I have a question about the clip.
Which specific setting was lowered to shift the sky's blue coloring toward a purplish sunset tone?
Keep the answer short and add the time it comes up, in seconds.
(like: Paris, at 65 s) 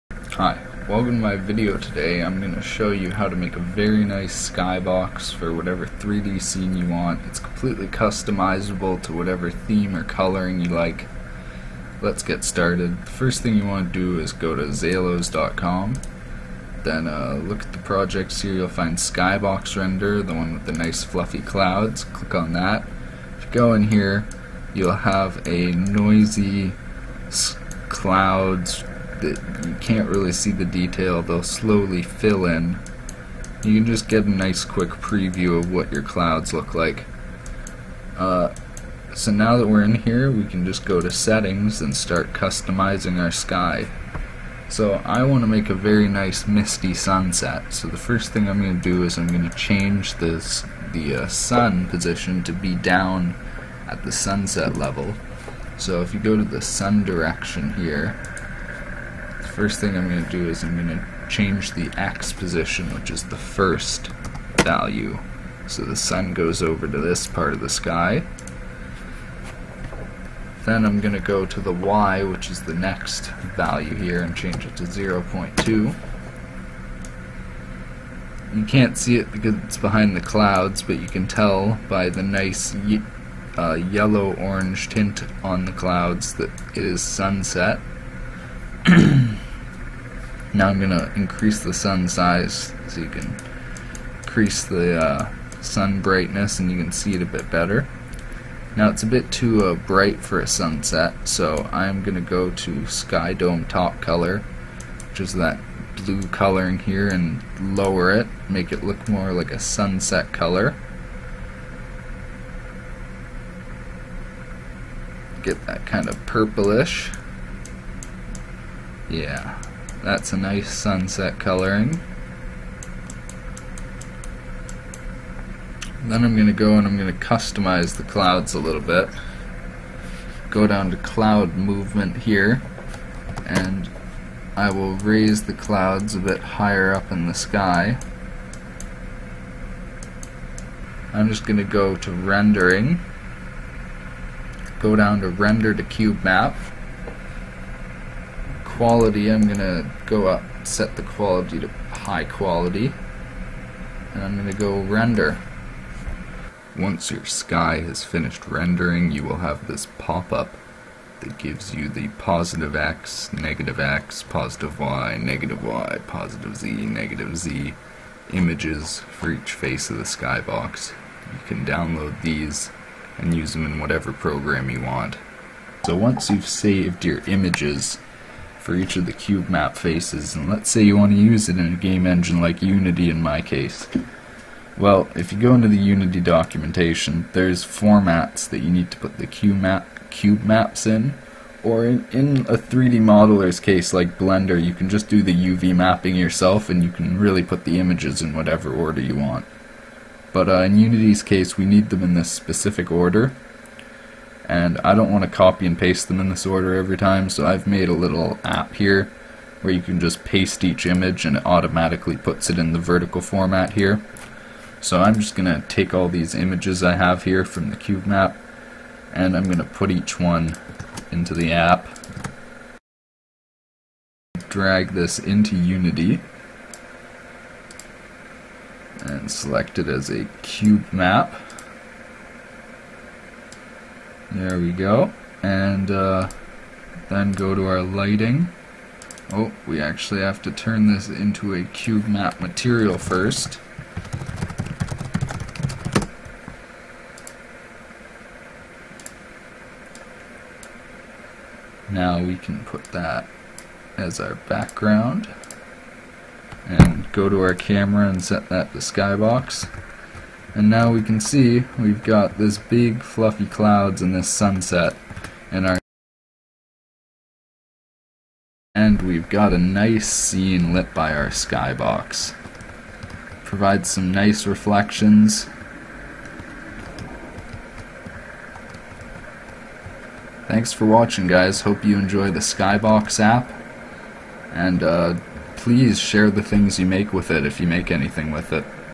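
Sky Dome Top Color, at 102 s.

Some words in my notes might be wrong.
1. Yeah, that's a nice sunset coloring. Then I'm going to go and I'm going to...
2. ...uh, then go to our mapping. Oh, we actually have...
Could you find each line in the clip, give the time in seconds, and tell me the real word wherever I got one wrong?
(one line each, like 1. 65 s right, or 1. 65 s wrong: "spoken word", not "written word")
1. 119 s right
2. 235 s wrong: "lighting", not "mapping".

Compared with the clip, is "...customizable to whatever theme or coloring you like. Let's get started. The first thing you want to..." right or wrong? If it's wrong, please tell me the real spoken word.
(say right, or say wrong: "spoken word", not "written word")
right.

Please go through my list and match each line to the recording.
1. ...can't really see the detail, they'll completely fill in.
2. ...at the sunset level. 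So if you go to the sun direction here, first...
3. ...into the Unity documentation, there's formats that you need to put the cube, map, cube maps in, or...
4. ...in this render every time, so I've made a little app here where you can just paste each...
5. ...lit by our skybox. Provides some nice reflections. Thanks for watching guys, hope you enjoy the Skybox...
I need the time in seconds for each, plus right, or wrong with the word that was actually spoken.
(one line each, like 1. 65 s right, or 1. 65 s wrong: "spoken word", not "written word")
1. 29 s wrong: "slowly", not "completely"
2. 53 s right
3. 185 s right
4. 206 s wrong: "order", not "render"
5. 270 s right.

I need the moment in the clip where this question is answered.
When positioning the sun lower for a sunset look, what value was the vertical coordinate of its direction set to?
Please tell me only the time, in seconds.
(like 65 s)
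74 s.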